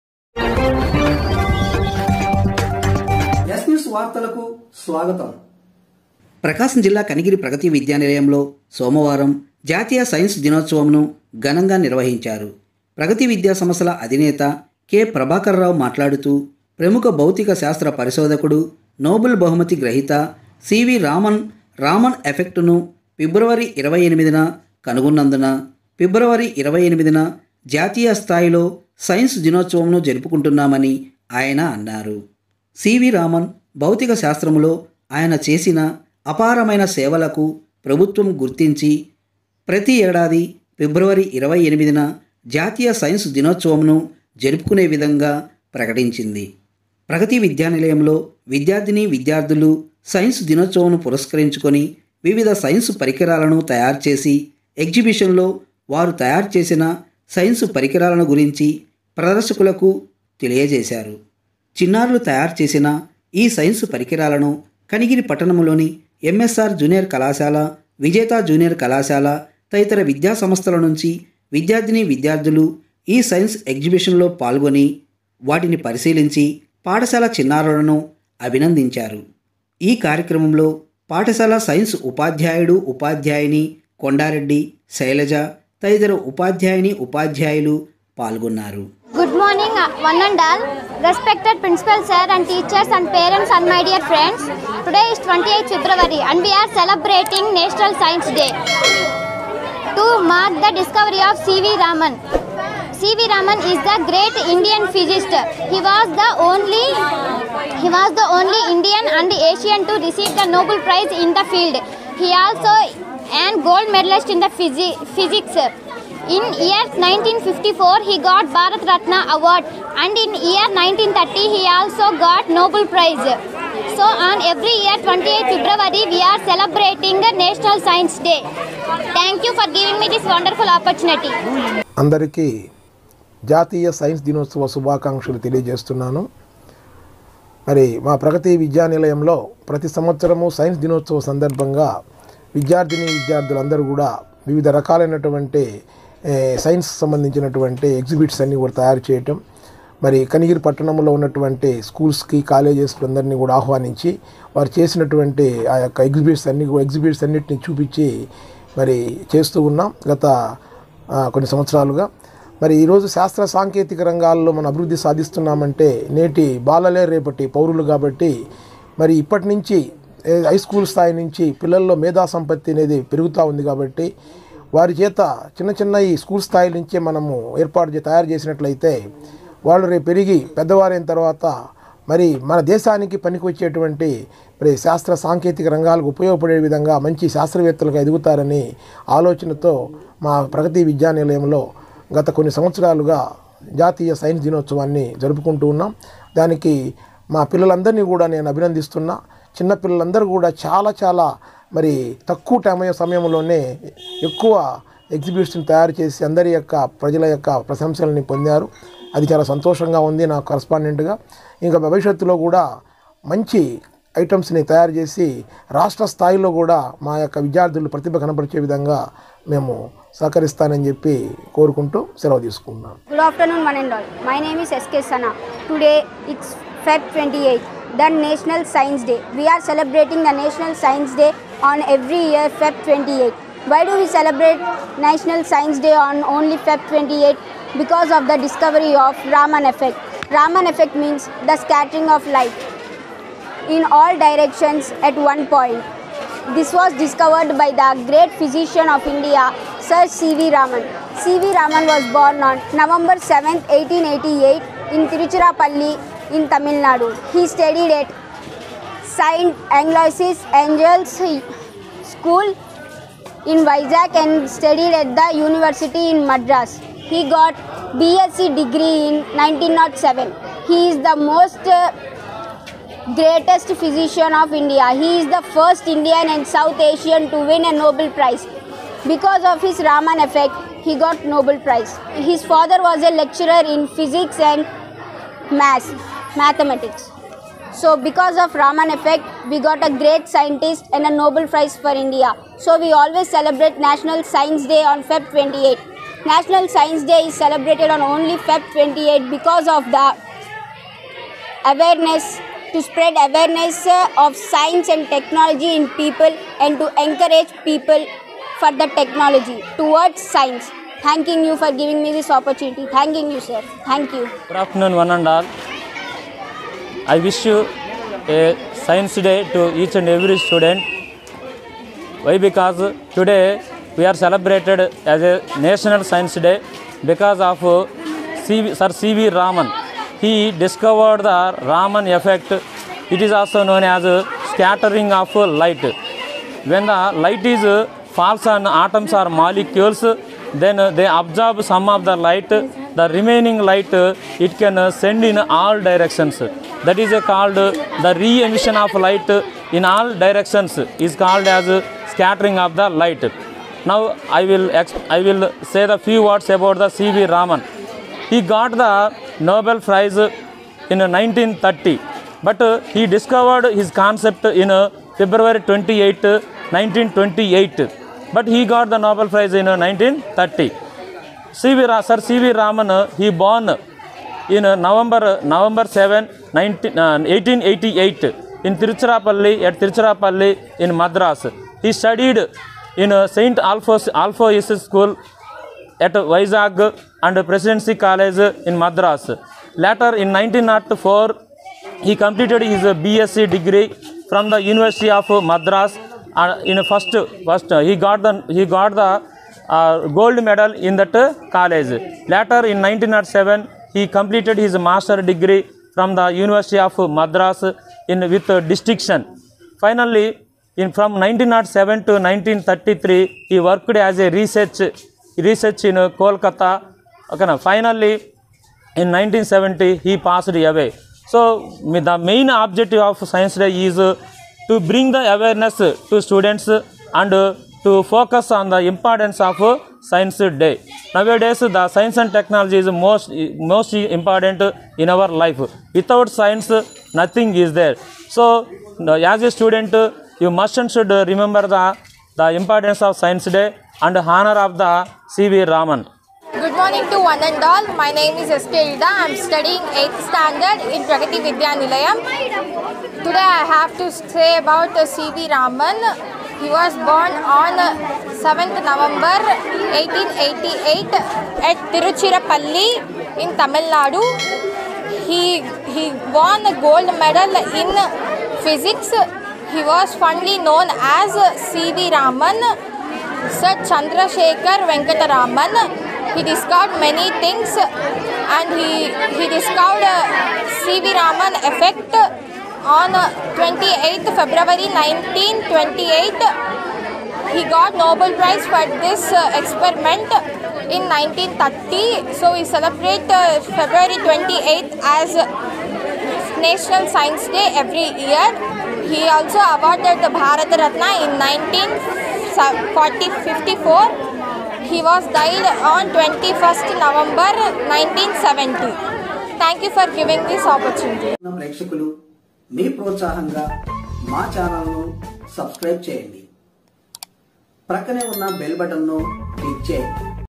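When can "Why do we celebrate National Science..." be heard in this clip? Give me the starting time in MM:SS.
03:53.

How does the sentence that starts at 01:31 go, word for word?
Respected principal sir and teachers and parents and my dear friends.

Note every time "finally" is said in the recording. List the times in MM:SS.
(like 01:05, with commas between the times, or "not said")
06:49, 06:57.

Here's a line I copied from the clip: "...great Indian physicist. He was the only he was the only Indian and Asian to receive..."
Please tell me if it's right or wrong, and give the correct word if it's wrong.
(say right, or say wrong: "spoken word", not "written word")
right.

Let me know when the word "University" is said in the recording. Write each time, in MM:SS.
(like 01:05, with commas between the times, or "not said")
04:25, 06:34, 06:46.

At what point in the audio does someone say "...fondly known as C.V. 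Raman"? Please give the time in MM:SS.
07:50.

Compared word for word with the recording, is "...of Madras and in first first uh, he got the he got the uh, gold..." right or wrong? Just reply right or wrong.
right.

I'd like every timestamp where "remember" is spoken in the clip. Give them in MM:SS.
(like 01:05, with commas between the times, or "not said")
07:21.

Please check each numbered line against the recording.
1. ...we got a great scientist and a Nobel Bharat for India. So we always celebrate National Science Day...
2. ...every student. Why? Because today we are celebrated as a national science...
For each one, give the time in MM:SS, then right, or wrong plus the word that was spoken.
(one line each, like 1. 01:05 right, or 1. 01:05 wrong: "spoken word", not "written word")
1. 04:49 wrong: "Prize", not "Bharat"
2. 05:20 right.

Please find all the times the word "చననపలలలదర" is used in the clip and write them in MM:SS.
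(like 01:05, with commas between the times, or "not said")
03:19.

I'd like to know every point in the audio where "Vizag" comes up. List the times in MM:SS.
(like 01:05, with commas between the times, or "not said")
04:23, 06:26.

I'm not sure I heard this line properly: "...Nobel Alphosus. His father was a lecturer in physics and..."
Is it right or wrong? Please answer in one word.
wrong.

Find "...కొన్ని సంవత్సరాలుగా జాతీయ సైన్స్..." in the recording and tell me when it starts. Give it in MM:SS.
03:12.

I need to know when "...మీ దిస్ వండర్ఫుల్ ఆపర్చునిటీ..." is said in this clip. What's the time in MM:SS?
02:10.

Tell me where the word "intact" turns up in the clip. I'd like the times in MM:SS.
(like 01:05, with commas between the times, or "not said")
not said.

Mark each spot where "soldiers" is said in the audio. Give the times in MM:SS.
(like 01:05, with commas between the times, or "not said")
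not said.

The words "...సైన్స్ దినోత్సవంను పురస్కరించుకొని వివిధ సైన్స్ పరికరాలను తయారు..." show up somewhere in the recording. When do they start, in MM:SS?
00:50.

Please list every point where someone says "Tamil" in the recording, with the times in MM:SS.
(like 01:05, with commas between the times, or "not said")
04:16, 07:43.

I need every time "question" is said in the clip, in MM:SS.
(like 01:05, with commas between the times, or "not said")
not said.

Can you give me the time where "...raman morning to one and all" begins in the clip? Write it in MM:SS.
07:25.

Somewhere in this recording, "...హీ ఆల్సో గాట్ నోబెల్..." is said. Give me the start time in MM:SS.
02:01.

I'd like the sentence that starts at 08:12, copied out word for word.
So we celebrate uh, February 28th as National Science Day every year.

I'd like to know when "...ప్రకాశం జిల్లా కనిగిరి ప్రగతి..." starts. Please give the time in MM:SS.
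00:06.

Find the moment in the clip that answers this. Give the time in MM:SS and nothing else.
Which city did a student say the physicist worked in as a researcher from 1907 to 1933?
06:56.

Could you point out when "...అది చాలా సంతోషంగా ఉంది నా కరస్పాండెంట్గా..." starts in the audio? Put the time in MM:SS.
03:29.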